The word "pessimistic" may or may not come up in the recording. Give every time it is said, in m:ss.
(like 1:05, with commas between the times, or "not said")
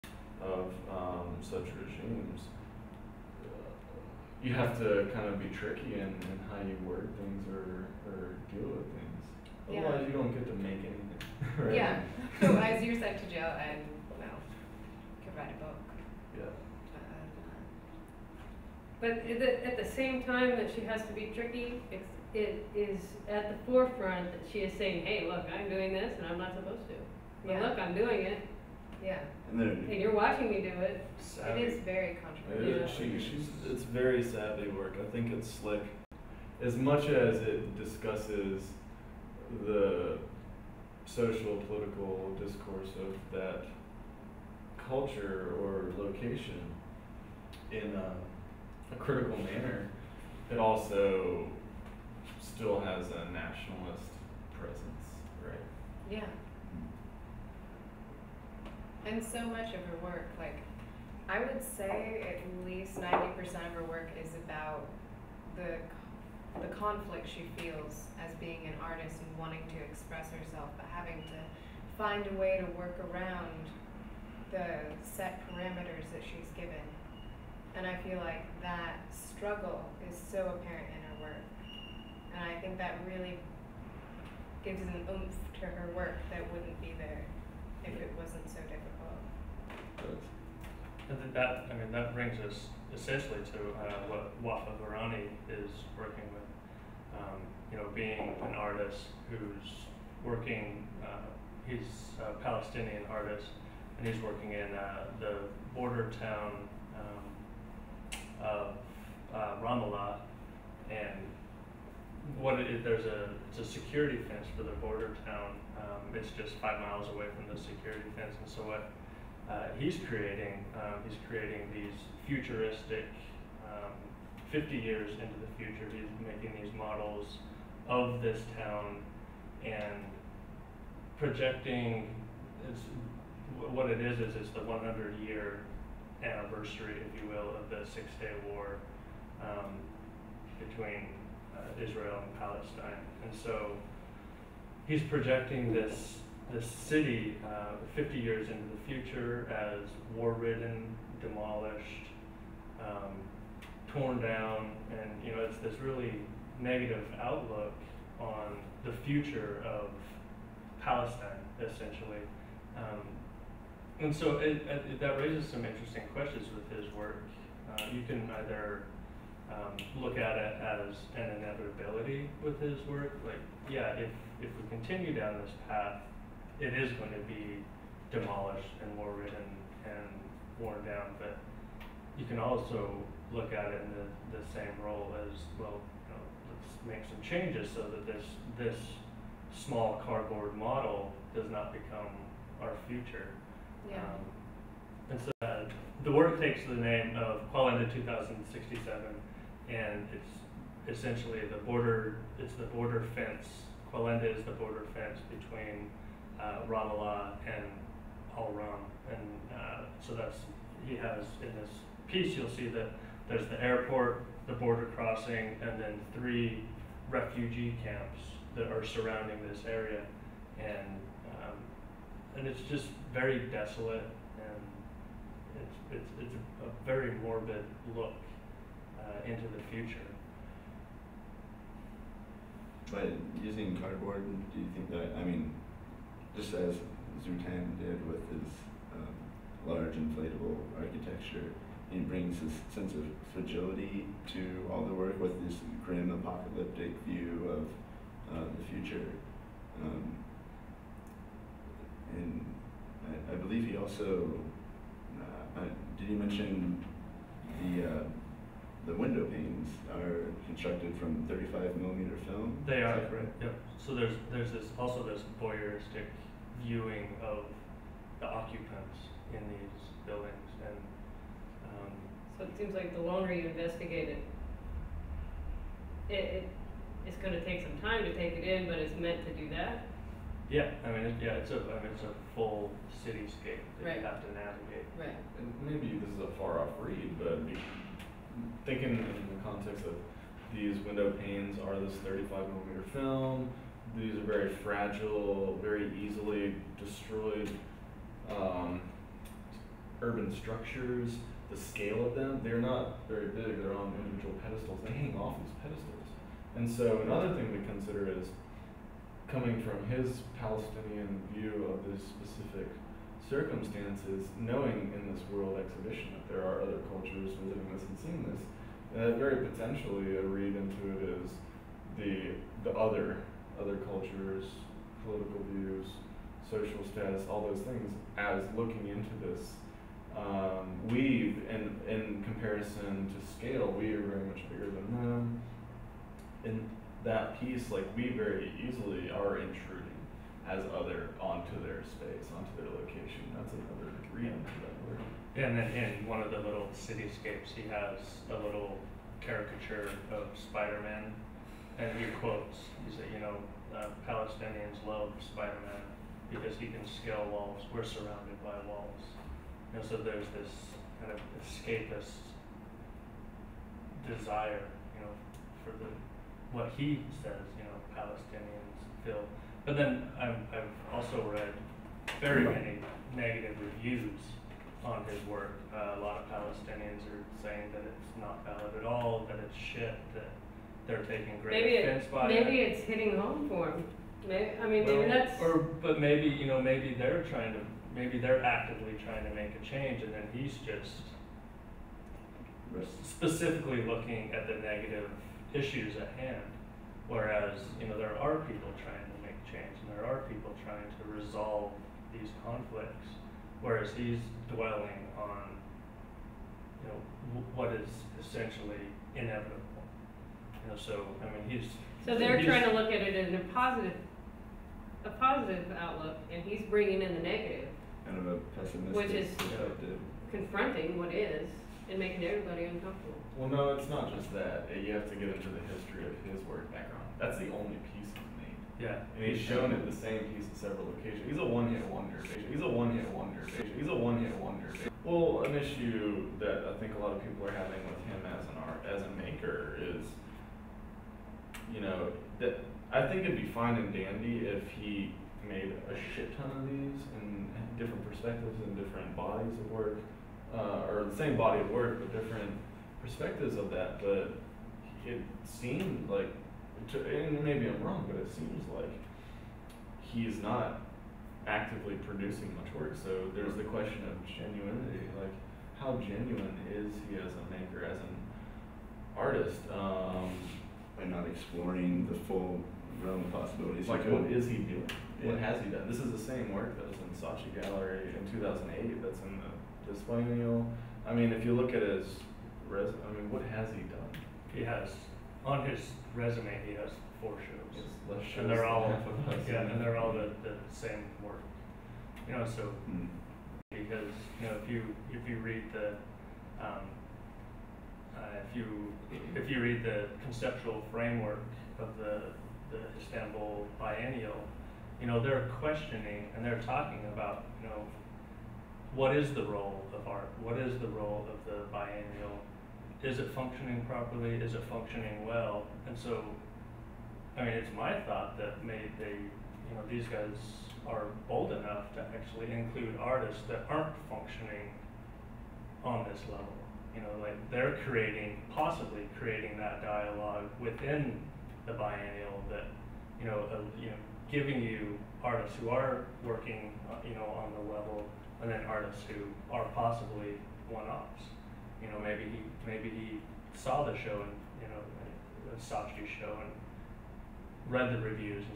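6:58.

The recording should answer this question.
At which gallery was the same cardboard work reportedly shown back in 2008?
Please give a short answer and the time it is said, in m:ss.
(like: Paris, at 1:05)
Saatchi Gallery, at 7:57.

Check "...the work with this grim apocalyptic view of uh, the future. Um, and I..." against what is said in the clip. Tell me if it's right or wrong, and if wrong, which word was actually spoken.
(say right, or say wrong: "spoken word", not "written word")
right.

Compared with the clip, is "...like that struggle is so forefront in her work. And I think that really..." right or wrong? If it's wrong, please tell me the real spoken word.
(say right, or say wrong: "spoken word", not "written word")
wrong: "apparent", not "forefront".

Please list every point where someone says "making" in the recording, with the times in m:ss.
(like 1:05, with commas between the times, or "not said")
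2:06, 7:01.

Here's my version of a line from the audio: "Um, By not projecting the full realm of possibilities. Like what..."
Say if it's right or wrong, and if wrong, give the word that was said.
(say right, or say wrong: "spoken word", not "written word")
wrong: "exploring", not "projecting".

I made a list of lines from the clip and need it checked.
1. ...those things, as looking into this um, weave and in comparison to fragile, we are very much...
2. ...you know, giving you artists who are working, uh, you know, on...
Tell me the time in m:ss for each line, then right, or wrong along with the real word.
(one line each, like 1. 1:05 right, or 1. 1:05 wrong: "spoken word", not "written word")
1. 5:27 wrong: "scale", not "fragile"
2. 8:53 right.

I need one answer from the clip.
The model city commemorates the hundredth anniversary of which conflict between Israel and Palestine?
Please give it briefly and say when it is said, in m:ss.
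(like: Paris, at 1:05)
Six Day War, at 2:17.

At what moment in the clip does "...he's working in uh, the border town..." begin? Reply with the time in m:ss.
1:44.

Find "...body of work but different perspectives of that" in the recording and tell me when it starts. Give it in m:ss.
7:31.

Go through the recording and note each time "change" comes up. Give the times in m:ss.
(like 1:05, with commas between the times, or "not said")
3:07, 6:29, 6:39.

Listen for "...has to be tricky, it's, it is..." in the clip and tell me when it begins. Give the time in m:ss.
0:20.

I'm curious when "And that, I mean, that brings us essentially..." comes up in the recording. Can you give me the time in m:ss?
1:31.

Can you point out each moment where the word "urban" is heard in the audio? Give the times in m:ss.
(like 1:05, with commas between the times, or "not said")
5:00.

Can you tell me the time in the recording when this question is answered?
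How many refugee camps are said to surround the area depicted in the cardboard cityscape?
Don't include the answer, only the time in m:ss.
3:36.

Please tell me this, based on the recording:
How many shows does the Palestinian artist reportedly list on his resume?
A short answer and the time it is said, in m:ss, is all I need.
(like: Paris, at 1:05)
4, at 8:07.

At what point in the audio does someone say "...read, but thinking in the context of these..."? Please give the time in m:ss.
4:46.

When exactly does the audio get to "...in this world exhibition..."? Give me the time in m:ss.
5:14.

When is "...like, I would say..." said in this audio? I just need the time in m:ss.
1:00.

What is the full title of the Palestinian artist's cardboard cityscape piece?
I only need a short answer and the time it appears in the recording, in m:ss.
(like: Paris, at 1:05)
Qalandia 2067, at 3:17.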